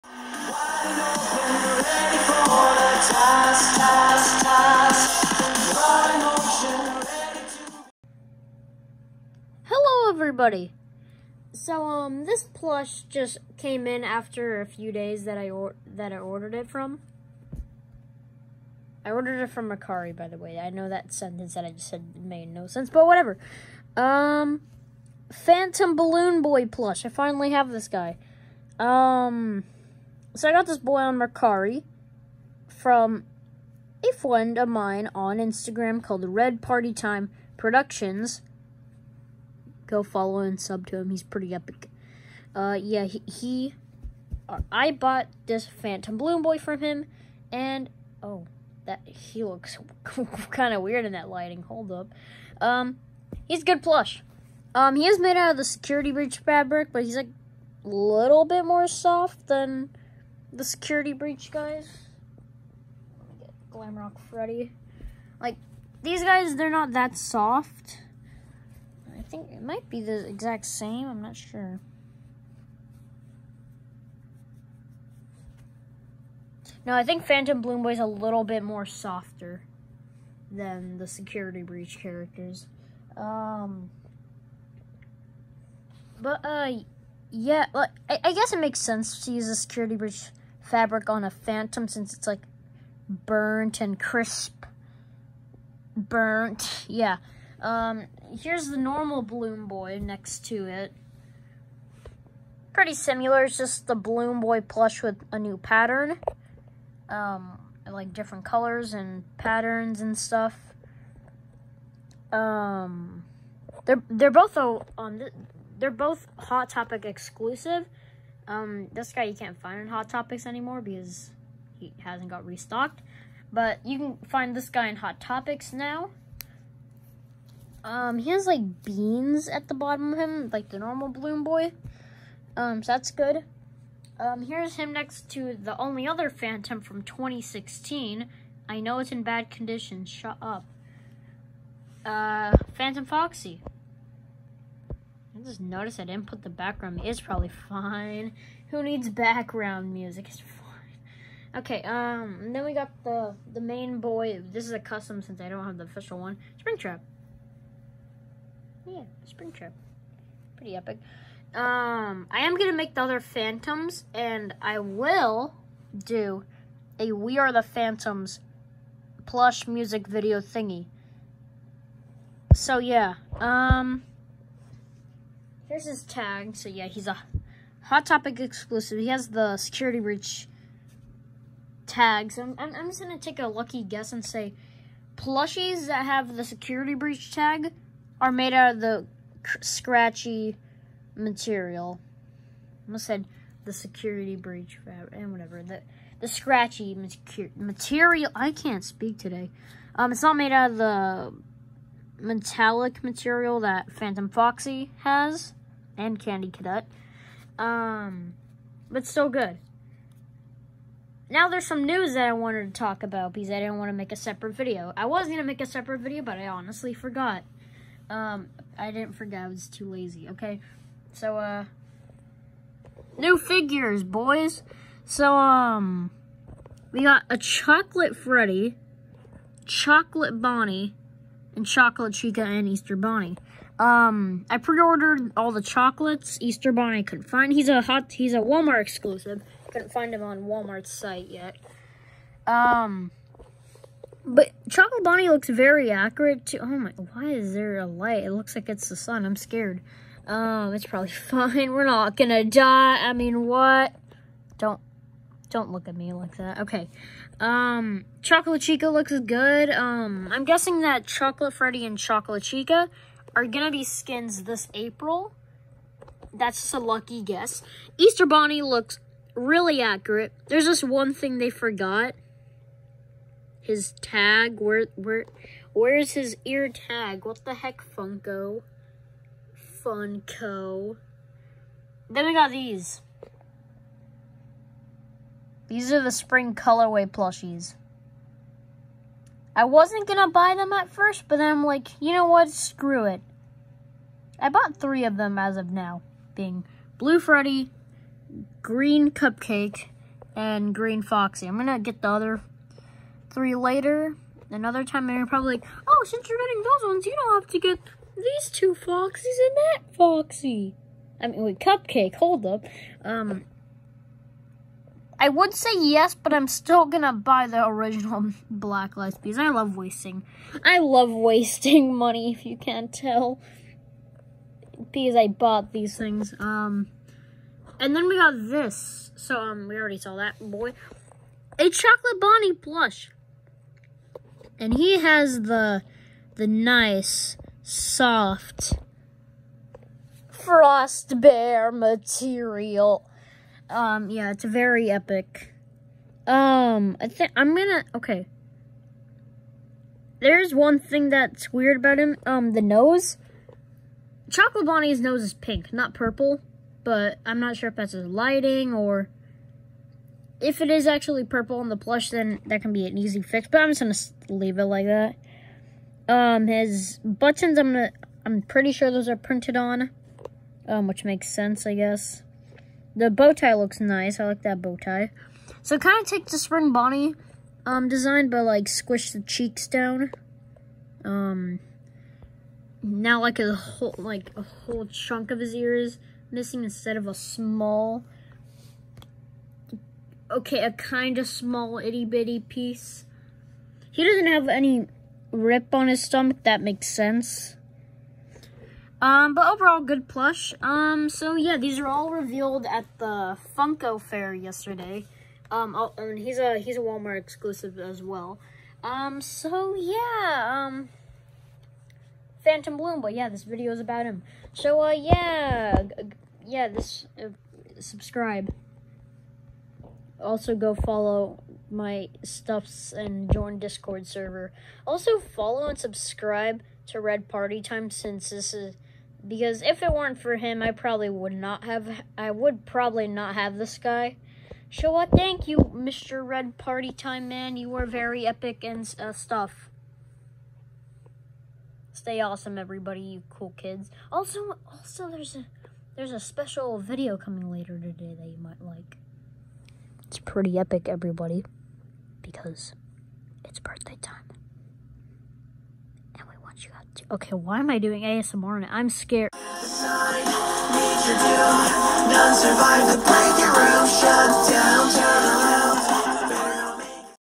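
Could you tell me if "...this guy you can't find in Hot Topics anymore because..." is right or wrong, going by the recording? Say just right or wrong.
right.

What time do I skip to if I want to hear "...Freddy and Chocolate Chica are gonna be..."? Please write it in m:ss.
4:21.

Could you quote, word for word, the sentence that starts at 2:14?
Um, here's him next to the only other Phantom from 2016.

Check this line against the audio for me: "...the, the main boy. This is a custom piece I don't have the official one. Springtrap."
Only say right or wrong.
wrong.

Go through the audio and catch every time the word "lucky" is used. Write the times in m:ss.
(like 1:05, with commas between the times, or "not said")
3:03, 4:26.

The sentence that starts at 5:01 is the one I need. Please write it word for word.
I'm gonna get the other three later.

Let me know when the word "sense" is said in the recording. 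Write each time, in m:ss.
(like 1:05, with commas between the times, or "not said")
0:22, 1:28, 6:11, 6:36.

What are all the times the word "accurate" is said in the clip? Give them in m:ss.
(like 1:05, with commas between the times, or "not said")
4:05, 4:29.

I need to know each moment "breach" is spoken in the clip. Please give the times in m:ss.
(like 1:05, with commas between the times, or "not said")
0:56, 1:01, 1:21, 1:29, 3:00, 3:06, 3:14.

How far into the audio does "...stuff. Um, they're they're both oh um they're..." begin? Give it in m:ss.
1:50.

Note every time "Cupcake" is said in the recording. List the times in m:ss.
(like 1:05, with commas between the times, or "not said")
4:59, 5:11.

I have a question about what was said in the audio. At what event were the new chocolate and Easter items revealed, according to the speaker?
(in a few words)
Funko Fair.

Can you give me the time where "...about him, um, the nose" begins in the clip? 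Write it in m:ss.
5:51.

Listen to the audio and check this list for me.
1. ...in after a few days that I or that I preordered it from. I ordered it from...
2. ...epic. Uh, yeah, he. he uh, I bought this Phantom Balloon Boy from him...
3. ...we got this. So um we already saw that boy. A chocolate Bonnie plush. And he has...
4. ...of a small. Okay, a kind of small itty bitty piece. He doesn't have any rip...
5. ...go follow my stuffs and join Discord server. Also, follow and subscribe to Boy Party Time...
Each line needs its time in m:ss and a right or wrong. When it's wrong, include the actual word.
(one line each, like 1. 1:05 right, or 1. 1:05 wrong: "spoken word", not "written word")
1. 0:13 wrong: "ordered", not "preordered"
2. 0:41 right
3. 5:28 right
4. 6:26 right
5. 7:00 wrong: "Red", not "Boy".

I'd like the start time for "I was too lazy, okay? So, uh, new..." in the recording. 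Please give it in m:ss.
3:39.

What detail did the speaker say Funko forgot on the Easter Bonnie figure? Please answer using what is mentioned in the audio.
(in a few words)
His ear tag.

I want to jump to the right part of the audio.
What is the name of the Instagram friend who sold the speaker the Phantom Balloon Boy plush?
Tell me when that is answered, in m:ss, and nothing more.
0:36.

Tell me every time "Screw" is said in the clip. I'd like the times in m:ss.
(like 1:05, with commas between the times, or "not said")
4:52.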